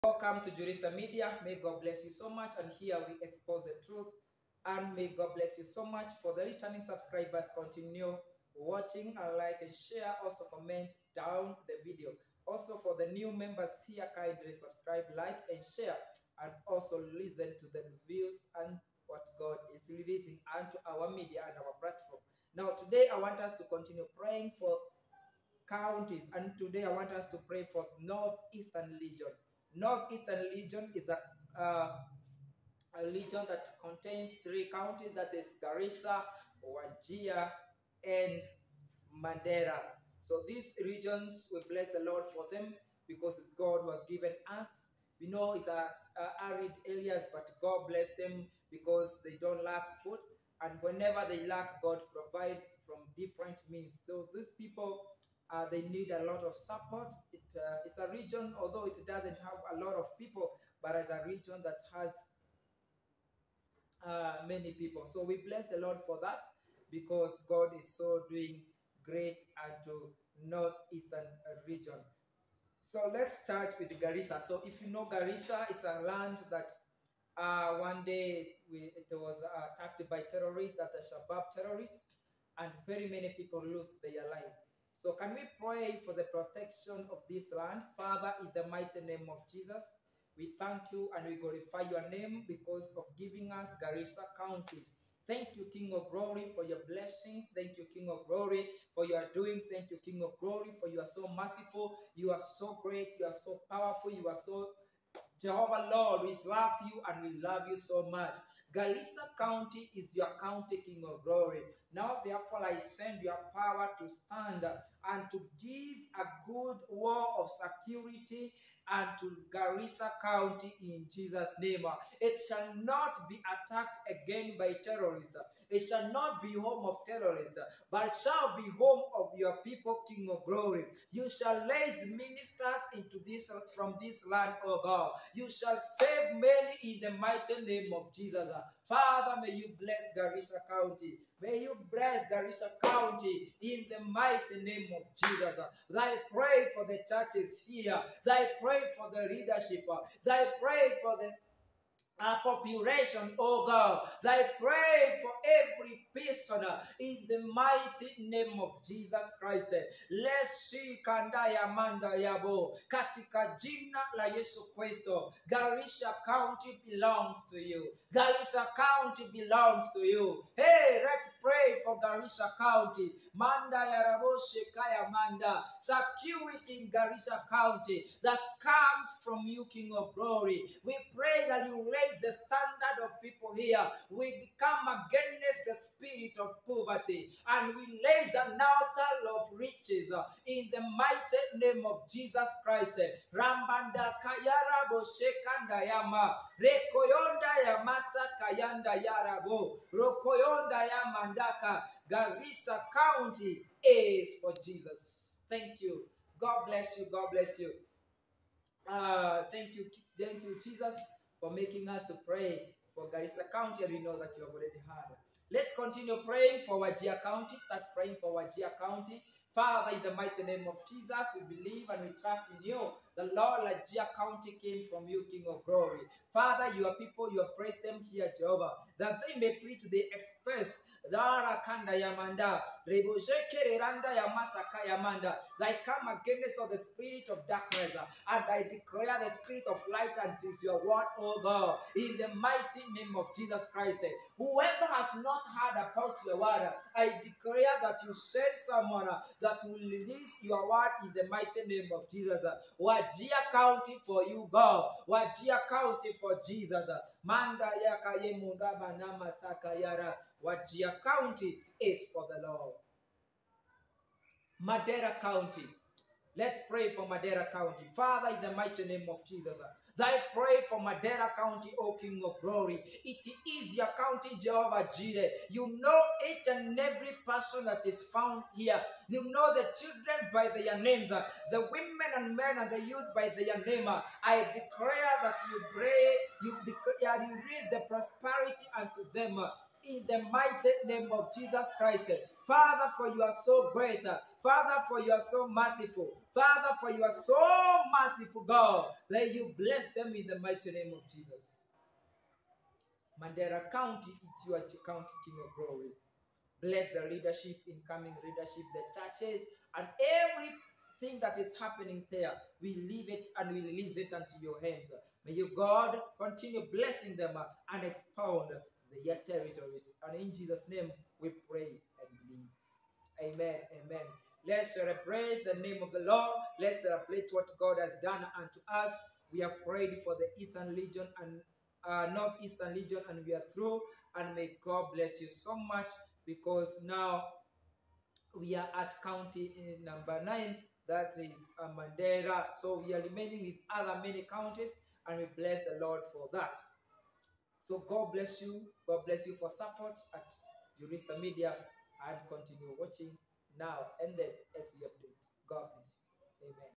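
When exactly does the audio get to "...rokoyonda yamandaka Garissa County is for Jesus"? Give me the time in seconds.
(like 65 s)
199 s.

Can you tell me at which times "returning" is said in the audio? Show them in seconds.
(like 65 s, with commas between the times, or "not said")
6 s.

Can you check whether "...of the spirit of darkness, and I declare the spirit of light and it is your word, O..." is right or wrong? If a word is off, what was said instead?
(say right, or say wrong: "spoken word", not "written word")
right.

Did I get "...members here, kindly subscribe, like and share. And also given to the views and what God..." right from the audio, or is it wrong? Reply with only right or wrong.
wrong.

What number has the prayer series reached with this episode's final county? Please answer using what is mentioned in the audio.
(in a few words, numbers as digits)
9.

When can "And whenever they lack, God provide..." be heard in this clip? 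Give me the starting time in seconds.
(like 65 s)
50 s.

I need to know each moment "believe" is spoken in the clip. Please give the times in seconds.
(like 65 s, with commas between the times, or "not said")
221 s, 322 s.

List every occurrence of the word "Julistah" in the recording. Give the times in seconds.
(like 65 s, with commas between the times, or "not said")
0 s, 350 s.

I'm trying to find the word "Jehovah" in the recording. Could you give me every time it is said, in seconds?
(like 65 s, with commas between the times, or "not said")
105 s, 228 s, 274 s.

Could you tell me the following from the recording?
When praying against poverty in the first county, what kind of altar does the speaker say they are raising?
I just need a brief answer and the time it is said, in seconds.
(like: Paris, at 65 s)
An altar of riches, at 188 s.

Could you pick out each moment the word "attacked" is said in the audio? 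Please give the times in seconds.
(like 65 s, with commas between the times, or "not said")
79 s, 123 s.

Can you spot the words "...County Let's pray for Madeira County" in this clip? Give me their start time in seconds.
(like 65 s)
265 s.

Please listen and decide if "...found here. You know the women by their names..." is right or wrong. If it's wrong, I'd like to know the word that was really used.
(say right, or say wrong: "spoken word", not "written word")
wrong: "children", not "women".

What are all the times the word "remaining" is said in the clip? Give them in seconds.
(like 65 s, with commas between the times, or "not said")
343 s.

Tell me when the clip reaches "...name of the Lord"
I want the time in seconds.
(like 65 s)
325 s.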